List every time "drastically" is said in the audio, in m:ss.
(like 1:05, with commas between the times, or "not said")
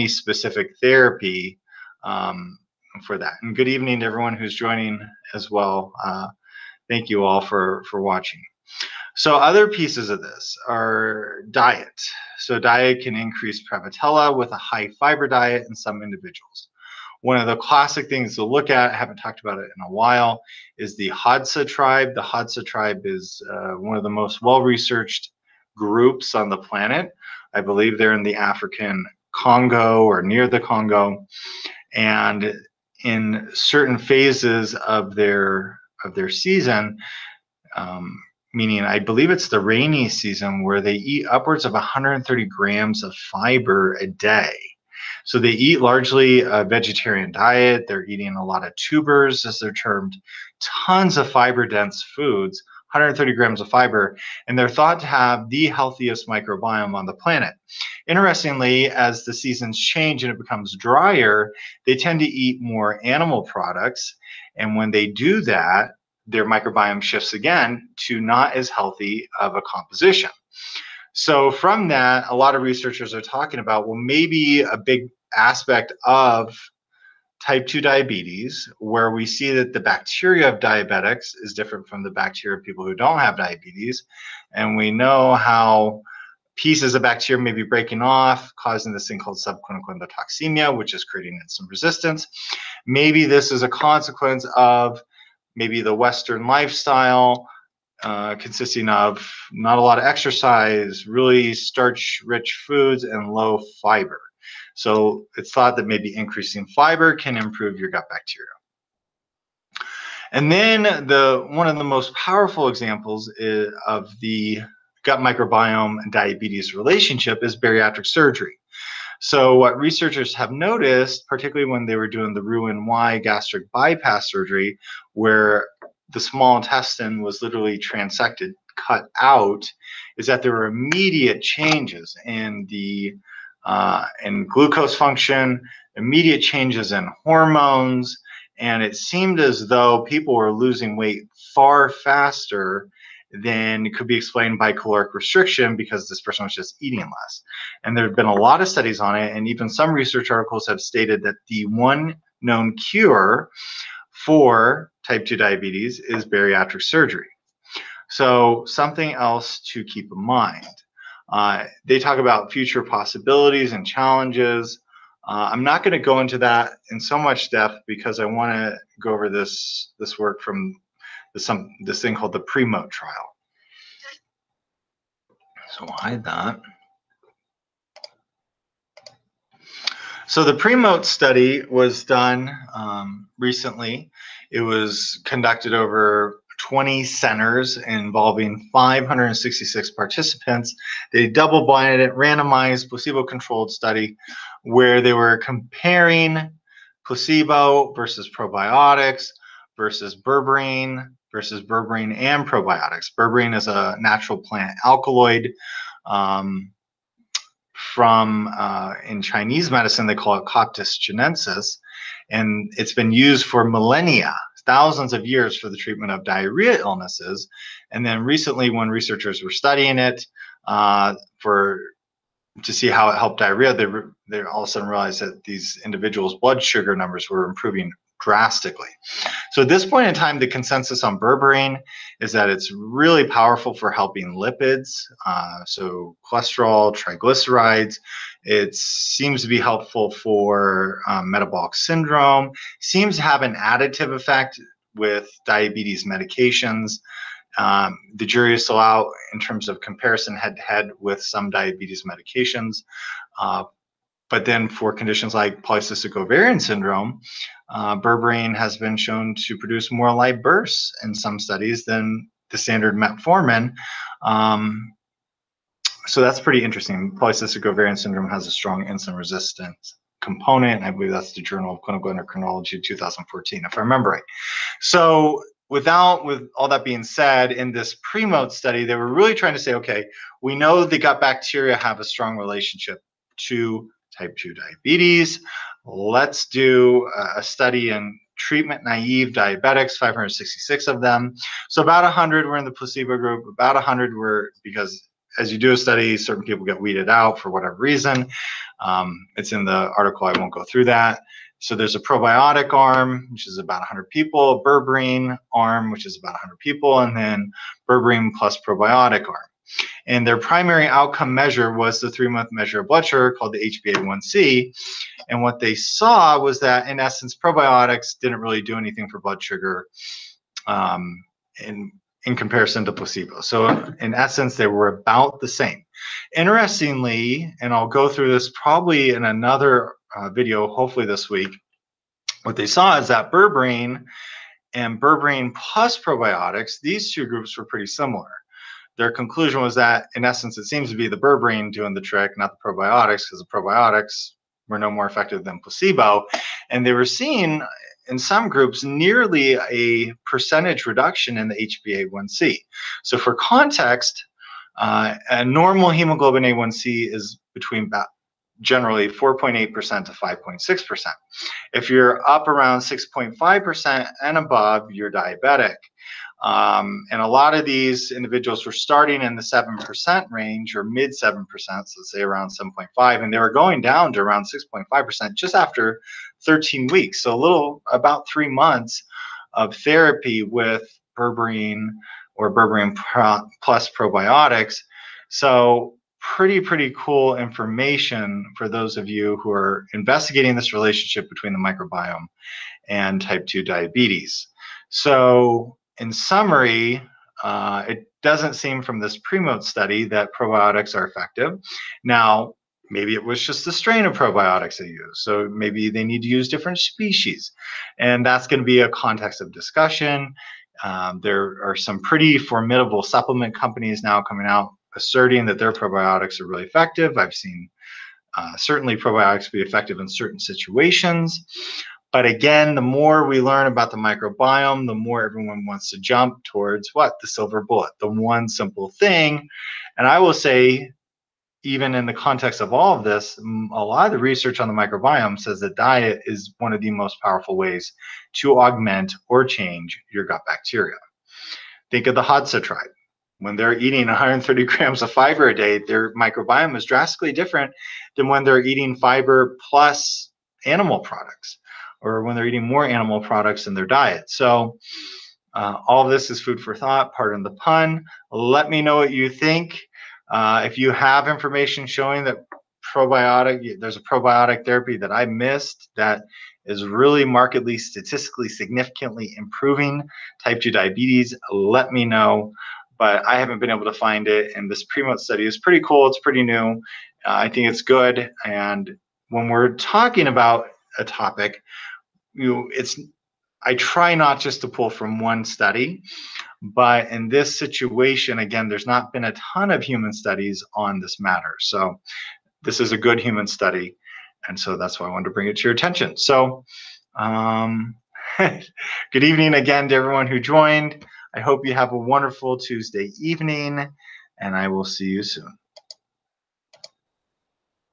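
3:48, 7:26.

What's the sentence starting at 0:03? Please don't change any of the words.
And good evening to everyone who's joining as well.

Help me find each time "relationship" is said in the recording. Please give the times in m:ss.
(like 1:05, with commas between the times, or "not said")
1:56, 4:42, 6:30.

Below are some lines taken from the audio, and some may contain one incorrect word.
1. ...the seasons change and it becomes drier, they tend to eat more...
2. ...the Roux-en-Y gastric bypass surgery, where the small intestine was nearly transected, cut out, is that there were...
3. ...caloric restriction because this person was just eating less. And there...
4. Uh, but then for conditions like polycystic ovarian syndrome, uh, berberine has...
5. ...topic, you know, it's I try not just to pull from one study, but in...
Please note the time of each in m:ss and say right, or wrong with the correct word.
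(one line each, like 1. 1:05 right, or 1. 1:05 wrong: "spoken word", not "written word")
1. 0:59 right
2. 2:02 wrong: "literally", not "nearly"
3. 2:24 right
4. 4:13 right
5. 8:01 right.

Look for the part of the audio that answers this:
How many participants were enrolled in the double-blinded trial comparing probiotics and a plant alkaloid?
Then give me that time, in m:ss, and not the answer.
3:08.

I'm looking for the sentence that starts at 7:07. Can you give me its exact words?
The silver bullet, the one simple thing.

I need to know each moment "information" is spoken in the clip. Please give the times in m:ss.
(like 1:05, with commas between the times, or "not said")
6:27, 7:41.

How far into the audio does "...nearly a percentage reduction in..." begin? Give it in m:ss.
5:48.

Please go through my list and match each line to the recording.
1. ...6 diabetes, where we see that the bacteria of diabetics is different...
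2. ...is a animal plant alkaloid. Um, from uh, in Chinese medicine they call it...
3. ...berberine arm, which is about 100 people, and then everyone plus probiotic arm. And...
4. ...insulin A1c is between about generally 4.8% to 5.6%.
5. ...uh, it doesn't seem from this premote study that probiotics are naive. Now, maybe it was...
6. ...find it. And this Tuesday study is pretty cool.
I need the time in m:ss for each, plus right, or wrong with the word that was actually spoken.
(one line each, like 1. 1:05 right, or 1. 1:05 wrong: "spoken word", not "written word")
1. 1:17 wrong: "2", not "6"
2. 3:23 wrong: "natural", not "animal"
3. 5:04 wrong: "berberine", not "everyone"
4. 5:55 wrong: "hemoglobin", not "insulin"
5. 6:37 wrong: "effective", not "naive"
6. 7:53 wrong: "Primo", not "Tuesday".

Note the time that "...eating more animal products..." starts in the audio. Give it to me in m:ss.
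7:32.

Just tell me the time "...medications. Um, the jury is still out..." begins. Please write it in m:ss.
4:06.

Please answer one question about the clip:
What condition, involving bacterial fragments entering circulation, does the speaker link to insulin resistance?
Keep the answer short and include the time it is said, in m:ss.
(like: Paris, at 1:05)
subclinical endotoxemia, at 1:29.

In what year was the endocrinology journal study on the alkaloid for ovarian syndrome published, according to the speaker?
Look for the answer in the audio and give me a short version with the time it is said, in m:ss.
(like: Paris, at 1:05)
2014, at 4:32.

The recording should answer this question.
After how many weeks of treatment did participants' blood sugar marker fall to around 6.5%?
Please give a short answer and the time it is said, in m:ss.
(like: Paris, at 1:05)
13, at 6:16.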